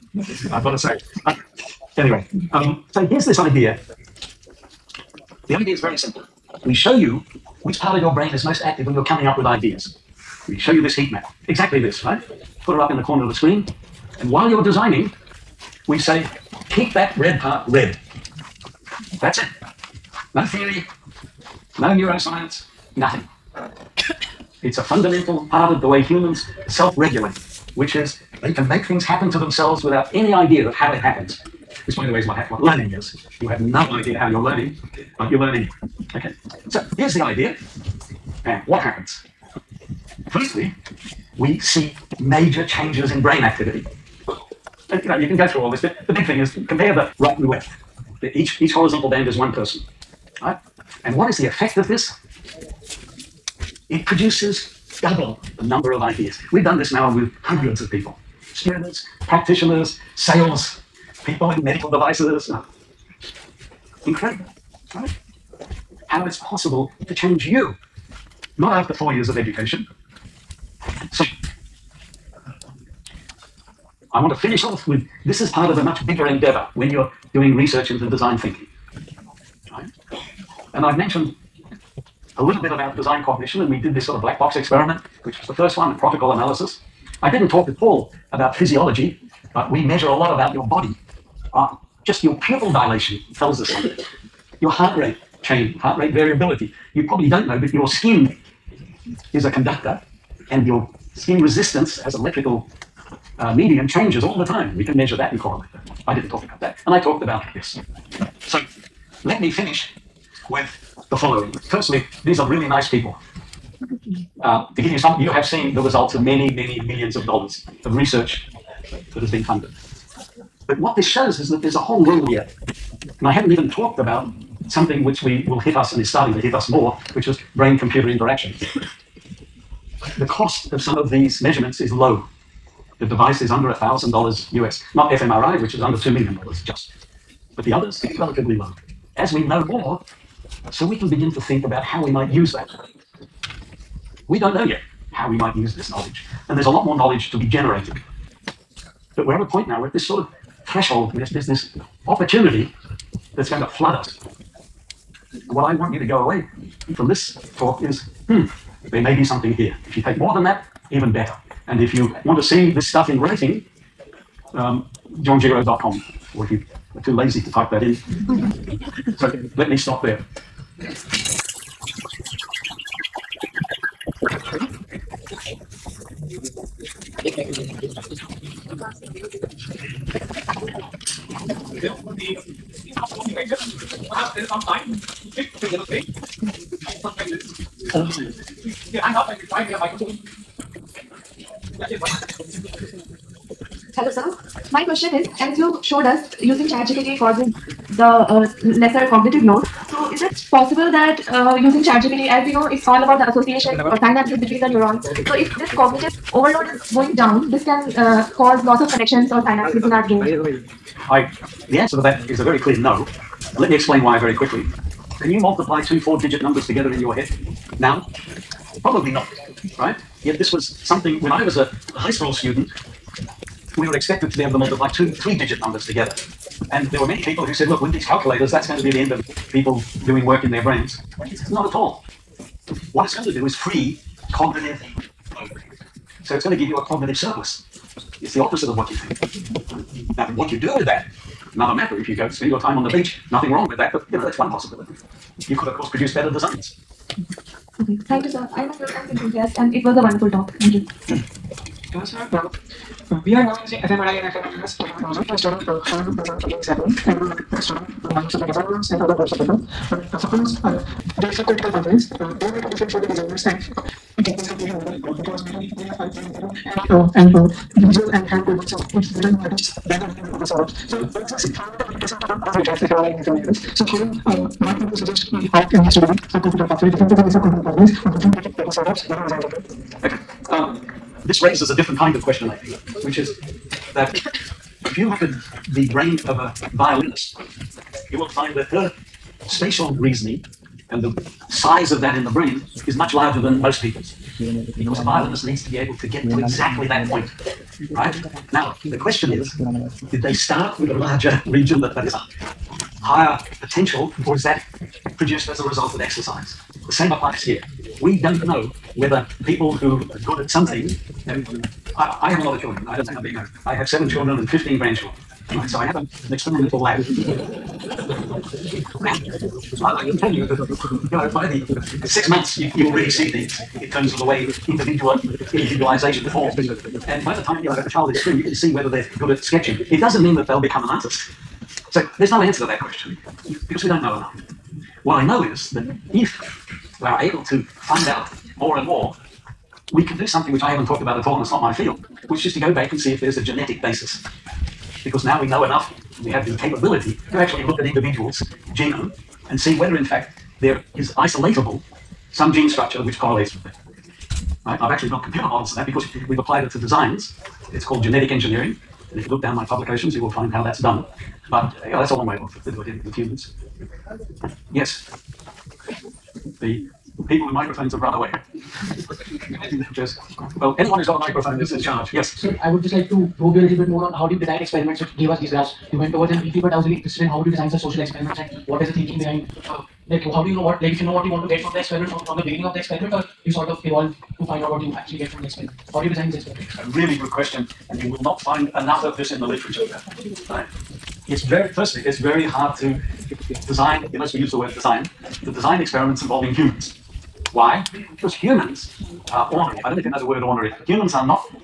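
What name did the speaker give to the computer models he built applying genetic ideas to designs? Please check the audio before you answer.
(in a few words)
genetic engineering.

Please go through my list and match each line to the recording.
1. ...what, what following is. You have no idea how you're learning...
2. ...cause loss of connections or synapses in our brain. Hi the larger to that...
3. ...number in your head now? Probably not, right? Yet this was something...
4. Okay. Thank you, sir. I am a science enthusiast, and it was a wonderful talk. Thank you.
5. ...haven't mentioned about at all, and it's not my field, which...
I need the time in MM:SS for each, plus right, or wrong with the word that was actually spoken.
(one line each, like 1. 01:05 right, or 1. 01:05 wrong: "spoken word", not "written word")
1. 00:32 wrong: "learning", not "following"
2. 03:28 wrong: "answer", not "larger"
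3. 03:36 wrong: "together", not "number"
4. 04:07 right
5. 05:40 wrong: "talked", not "mentioned".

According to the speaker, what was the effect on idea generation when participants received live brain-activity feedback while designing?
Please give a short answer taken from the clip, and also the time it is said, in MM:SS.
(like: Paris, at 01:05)
double the number of ideas, at 00:55.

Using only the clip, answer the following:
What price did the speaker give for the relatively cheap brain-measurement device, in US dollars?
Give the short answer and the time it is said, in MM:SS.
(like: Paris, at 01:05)
under $1,000, at 02:13.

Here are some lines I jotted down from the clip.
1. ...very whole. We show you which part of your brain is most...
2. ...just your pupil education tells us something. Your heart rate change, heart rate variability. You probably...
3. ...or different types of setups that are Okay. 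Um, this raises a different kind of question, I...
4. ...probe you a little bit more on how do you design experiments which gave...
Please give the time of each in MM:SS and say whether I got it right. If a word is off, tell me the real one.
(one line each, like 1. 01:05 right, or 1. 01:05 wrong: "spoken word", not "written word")
1. 00:05 wrong: "simple", not "whole"
2. 01:32 wrong: "dilation", not "education"
3. 04:38 right
4. 06:13 right.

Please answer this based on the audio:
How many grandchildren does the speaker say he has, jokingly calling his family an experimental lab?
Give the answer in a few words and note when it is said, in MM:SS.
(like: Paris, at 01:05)
15, at 05:14.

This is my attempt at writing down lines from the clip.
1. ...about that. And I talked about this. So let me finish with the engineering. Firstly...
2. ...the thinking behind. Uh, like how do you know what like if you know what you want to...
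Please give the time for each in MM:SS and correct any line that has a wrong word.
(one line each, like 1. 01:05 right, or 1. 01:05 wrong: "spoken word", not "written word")
1. 01:46 wrong: "following", not "engineering"
2. 06:18 right.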